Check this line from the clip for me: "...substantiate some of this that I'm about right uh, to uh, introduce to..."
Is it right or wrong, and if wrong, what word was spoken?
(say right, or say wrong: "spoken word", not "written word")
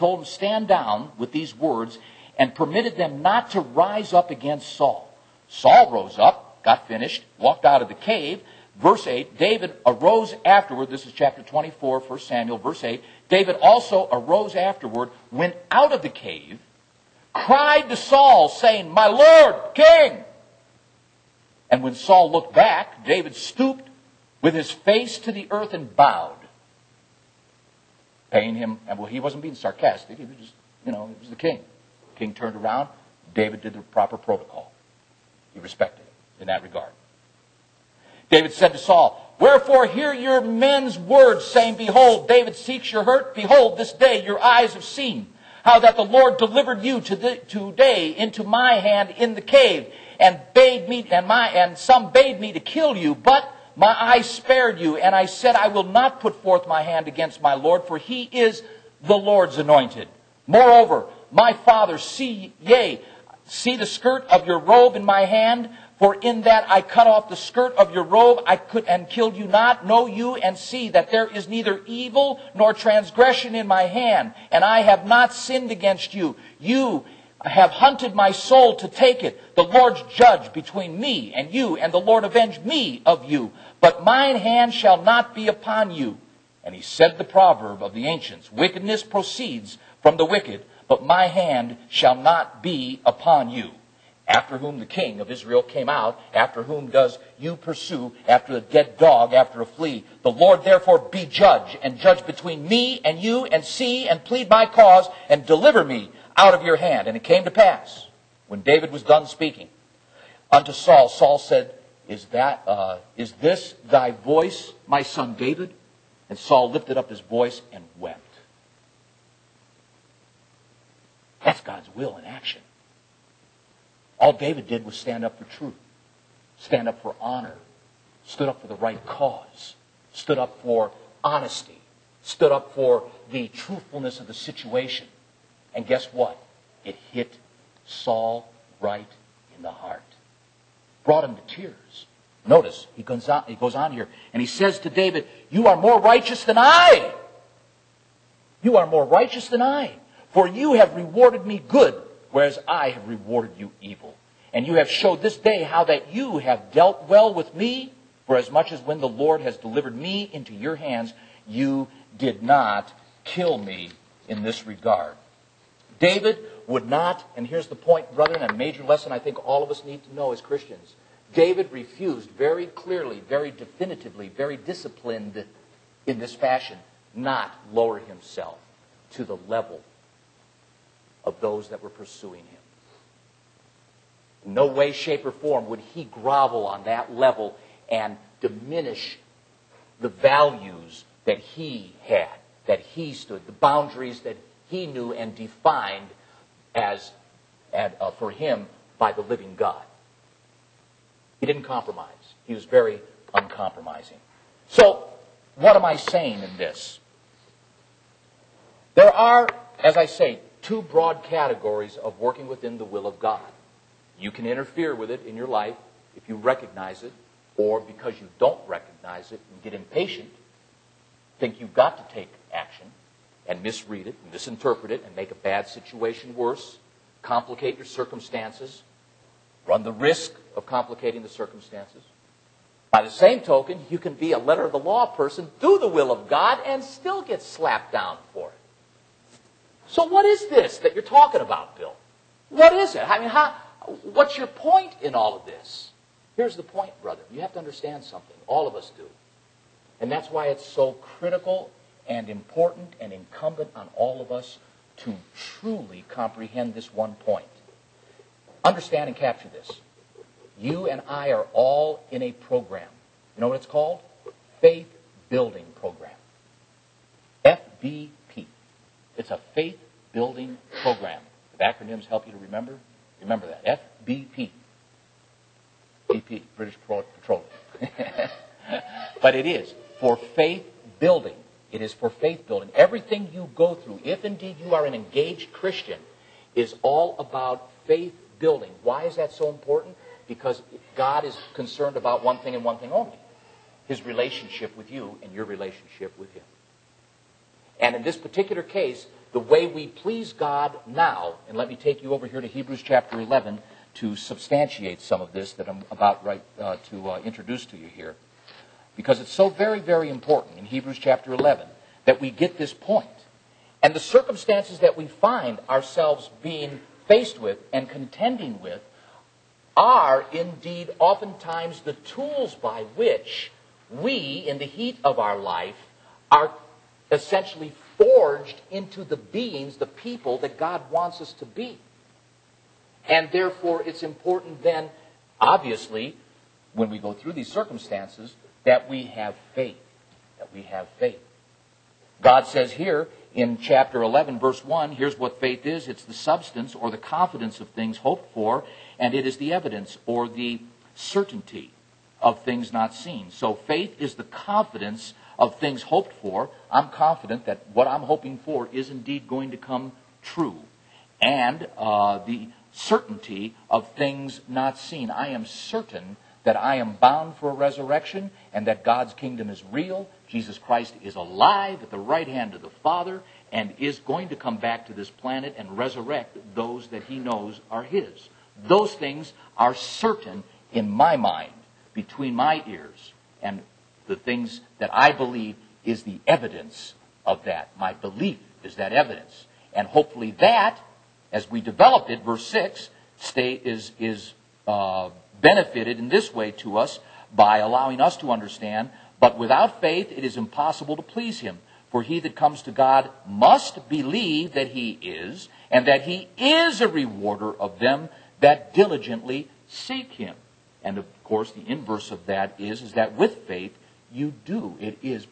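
right.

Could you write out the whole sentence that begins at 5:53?
So faith is the confidence of things hoped for, I'm confident that what I'm hoping for is indeed going to come true.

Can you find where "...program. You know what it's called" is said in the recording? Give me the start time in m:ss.
4:22.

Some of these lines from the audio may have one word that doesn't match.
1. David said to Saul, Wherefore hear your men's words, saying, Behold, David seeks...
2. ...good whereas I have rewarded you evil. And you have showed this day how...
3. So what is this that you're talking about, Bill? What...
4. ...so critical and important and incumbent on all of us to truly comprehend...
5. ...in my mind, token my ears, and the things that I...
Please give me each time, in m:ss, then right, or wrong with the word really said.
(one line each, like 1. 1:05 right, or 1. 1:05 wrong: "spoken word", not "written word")
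1. 0:38 right
2. 2:31 right
3. 3:59 right
4. 4:10 right
5. 6:20 wrong: "between", not "token".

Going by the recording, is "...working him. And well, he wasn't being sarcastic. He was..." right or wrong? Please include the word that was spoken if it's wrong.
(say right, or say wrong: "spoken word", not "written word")
wrong: "paying", not "working".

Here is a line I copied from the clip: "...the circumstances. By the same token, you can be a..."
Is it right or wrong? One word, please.
right.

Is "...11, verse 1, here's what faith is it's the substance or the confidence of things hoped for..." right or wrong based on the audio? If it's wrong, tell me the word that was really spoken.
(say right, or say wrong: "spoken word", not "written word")
right.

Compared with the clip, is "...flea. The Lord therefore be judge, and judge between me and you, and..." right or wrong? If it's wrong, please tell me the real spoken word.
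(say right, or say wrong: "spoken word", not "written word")
right.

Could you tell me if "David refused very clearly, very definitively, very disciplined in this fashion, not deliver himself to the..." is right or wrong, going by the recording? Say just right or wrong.
wrong.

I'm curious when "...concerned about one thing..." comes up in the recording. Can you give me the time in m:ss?
4:51.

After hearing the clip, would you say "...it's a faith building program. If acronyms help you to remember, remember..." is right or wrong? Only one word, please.
right.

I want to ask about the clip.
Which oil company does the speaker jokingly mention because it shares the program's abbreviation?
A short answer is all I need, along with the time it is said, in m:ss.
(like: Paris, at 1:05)
British Petroleum, at 4:36.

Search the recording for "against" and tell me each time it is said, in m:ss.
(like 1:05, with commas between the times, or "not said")
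0:04, 0:57, 1:15.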